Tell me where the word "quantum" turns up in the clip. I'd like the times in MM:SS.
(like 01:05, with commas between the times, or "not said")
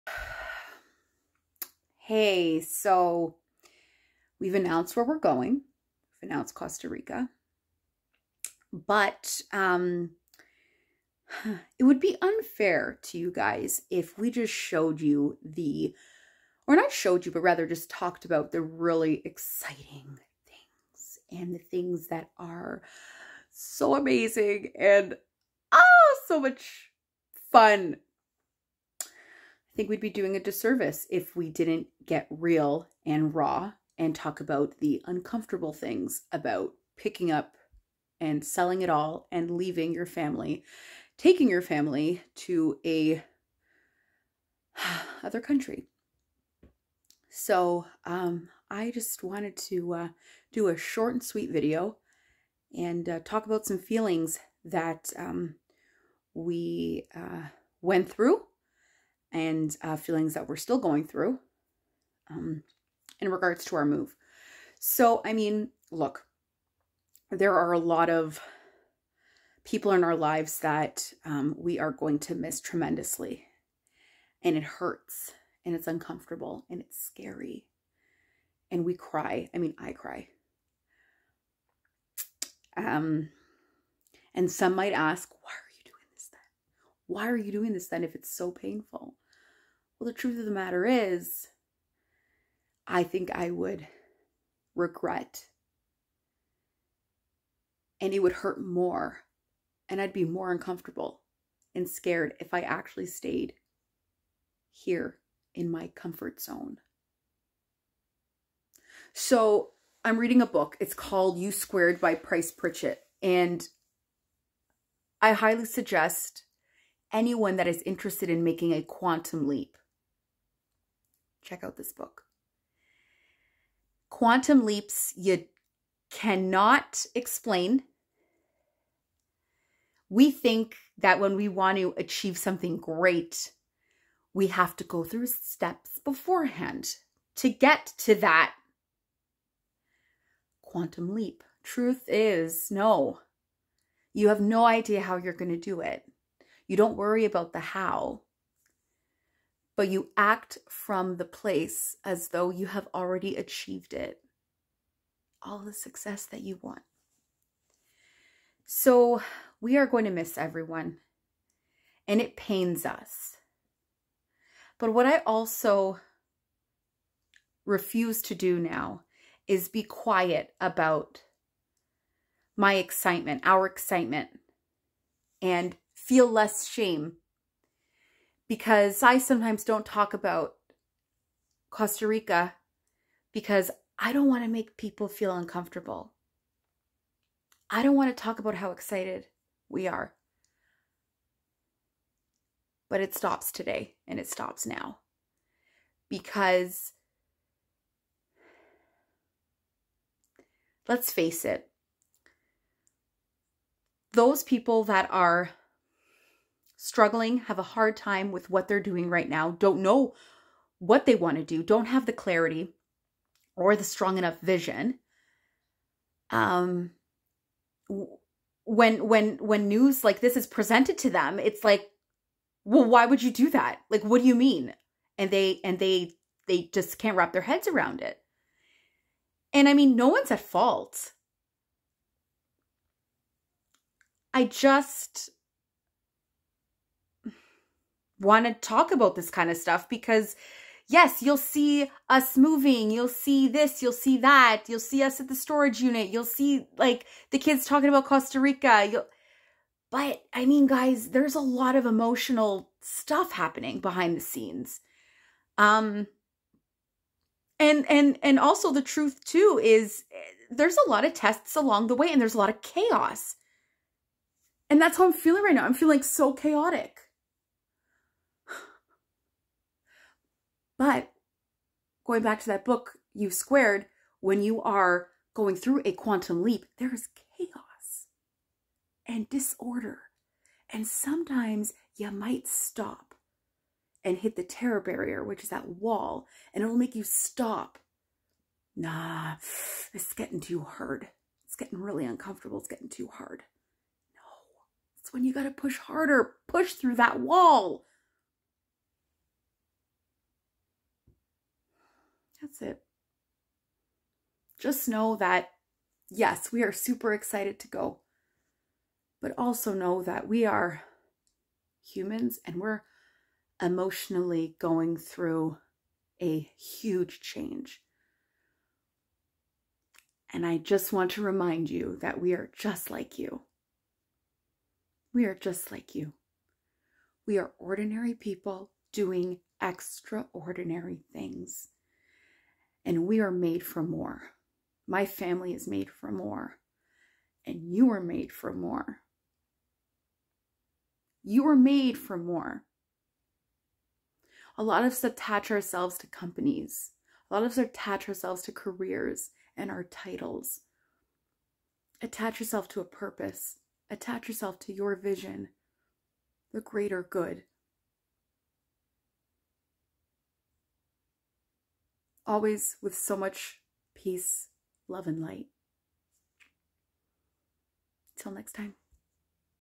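01:58, 02:04, 02:20, 04:35.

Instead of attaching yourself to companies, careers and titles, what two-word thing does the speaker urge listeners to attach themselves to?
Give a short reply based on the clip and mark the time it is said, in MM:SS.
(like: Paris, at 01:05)
a purpose, at 05:52.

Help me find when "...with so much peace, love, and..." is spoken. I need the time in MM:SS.
06:02.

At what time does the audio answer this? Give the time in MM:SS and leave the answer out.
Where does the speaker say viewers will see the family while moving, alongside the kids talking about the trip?
04:05.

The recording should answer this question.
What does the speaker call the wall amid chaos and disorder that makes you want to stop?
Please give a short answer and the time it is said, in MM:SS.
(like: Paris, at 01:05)
terror barrier, at 04:44.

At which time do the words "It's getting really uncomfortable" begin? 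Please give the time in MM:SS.
04:51.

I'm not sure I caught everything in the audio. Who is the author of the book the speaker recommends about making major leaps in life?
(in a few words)
Price Pritchett.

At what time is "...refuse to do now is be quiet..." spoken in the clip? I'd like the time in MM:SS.
02:47.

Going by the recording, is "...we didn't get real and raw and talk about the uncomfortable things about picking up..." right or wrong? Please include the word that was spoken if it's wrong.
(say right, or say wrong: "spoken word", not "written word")
right.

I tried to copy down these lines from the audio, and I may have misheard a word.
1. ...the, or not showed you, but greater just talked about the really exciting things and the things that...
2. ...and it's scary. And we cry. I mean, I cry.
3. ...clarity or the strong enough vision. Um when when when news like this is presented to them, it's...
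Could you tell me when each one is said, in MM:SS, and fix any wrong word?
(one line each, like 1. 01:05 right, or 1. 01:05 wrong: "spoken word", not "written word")
1. 00:15 wrong: "rather", not "greater"
2. 01:16 right
3. 03:32 right.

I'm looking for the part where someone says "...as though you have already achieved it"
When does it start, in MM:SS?
02:32.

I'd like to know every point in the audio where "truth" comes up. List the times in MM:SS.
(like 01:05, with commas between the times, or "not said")
01:30, 02:21, 04:18.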